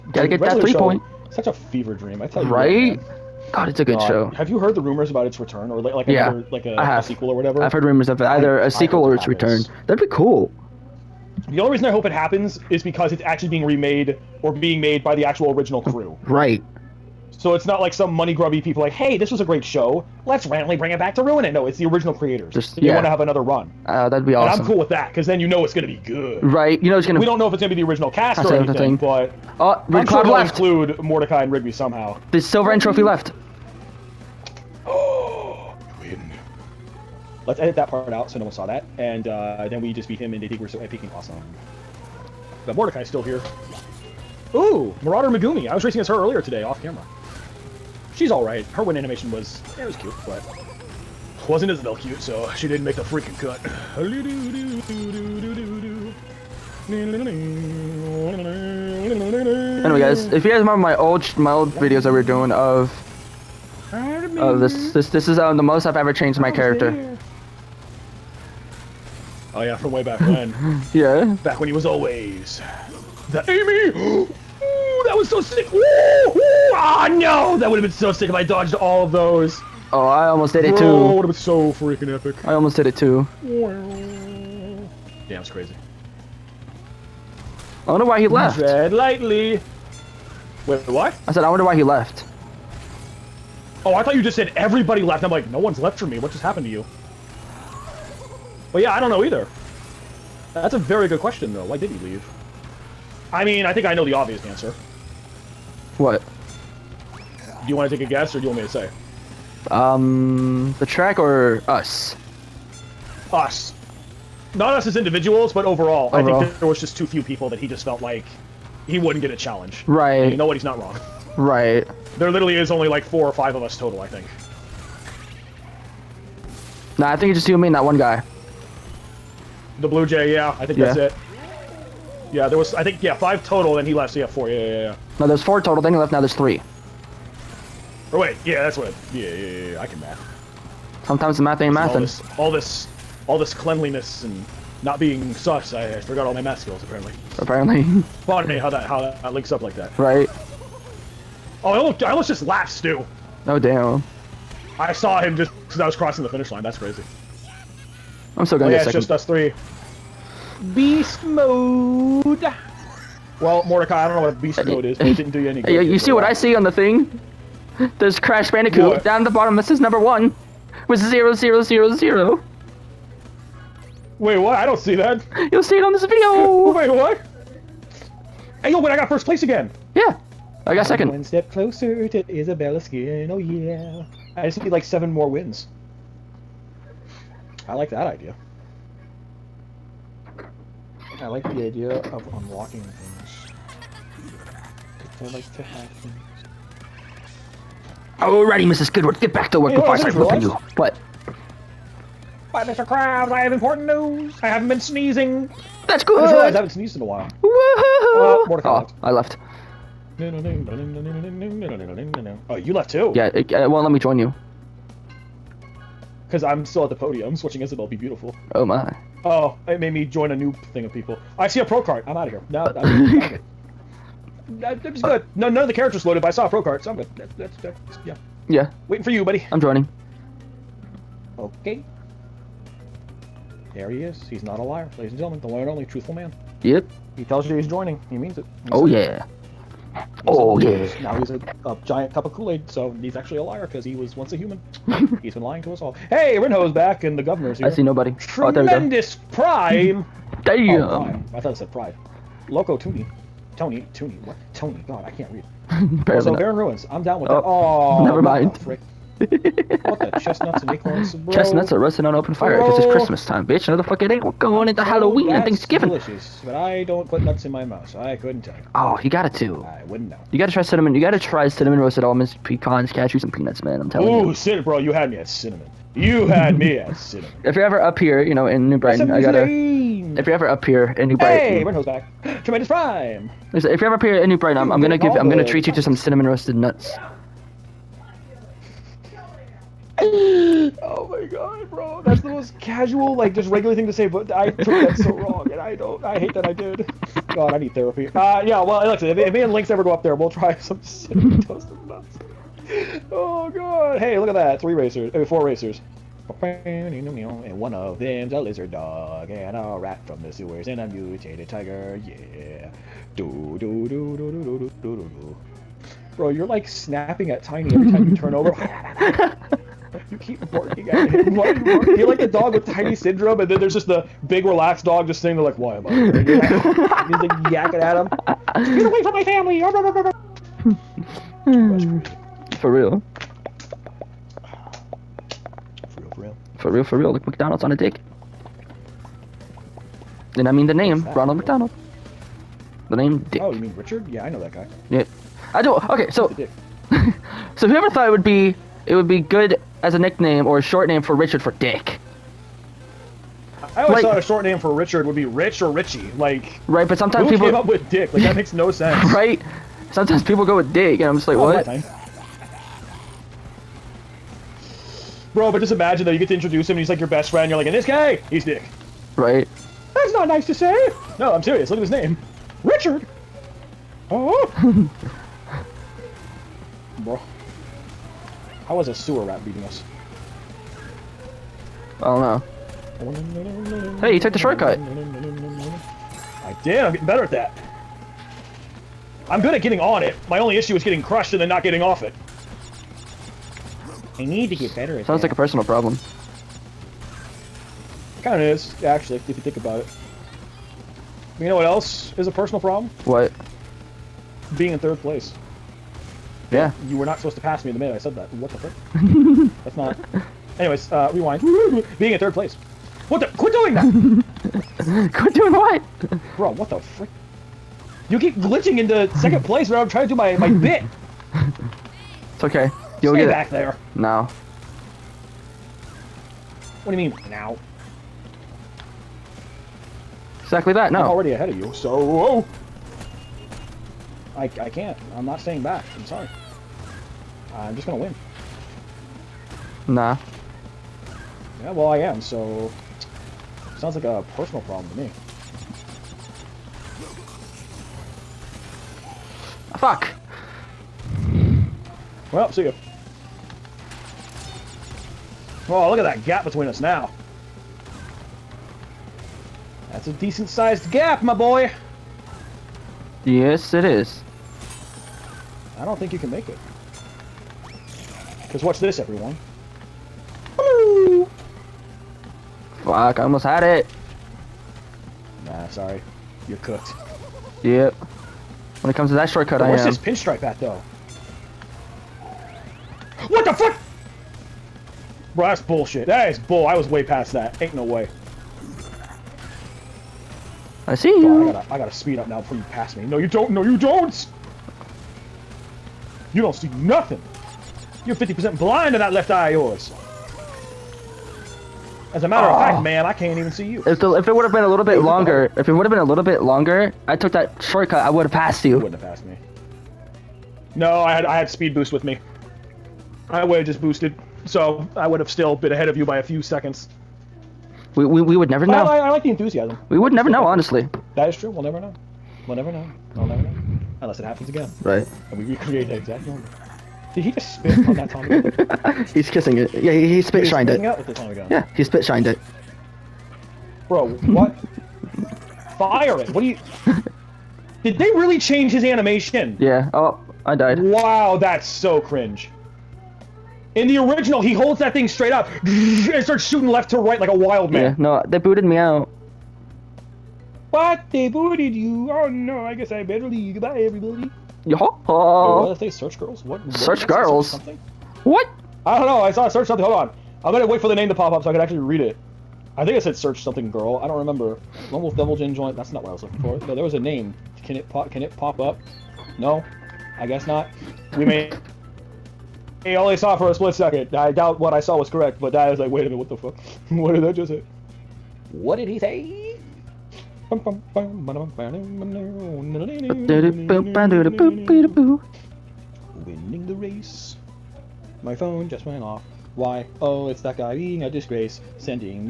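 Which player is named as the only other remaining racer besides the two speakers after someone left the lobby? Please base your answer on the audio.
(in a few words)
The Blue Jay.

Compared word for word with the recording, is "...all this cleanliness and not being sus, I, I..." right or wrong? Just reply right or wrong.
right.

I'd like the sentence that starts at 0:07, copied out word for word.
I've heard rumors of either I, a sequel or its return.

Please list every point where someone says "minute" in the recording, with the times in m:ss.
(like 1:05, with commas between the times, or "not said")
6:47, 9:36.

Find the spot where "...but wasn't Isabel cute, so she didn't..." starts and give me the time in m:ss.
0:50.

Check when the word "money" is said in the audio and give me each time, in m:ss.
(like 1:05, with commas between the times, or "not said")
0:18.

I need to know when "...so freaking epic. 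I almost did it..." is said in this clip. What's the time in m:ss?
1:21.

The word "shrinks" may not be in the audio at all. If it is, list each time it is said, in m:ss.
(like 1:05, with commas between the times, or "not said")
not said.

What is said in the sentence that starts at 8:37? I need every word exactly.
We we, we would never but know.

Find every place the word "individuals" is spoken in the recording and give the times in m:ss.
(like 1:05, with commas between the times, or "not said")
1:54.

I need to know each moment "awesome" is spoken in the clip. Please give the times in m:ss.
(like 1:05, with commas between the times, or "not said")
0:24, 0:41.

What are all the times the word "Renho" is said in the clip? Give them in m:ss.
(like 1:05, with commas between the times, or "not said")
4:06, 4:41.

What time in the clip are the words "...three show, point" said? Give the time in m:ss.
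0:00.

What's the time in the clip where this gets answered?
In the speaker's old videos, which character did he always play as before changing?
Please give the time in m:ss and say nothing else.
1:13.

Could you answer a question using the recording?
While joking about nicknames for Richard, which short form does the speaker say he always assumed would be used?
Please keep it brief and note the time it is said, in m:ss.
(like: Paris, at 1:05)
Rich or Richie, at 5:55.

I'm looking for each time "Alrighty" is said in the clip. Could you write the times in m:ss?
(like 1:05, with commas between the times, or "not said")
3:18.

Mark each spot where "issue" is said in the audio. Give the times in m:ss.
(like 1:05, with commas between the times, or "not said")
6:30.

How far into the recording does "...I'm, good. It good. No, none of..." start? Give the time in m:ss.
3:44.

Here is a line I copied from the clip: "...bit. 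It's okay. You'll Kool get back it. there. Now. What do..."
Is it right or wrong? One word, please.
wrong.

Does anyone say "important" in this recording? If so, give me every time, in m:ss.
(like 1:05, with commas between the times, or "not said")
3:23.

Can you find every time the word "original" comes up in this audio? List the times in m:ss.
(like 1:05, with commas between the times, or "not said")
0:15, 0:21, 0:27, 9:03.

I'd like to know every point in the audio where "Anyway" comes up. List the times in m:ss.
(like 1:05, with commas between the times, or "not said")
0:59, 6:50.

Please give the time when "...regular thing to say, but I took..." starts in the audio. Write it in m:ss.
4:53.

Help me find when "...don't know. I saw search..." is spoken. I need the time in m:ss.
9:18.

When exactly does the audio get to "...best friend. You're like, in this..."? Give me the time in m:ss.
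6:07.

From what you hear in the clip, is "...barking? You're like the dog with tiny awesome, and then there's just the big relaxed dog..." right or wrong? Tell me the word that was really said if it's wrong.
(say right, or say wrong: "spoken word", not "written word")
wrong: "syndrome", not "awesome".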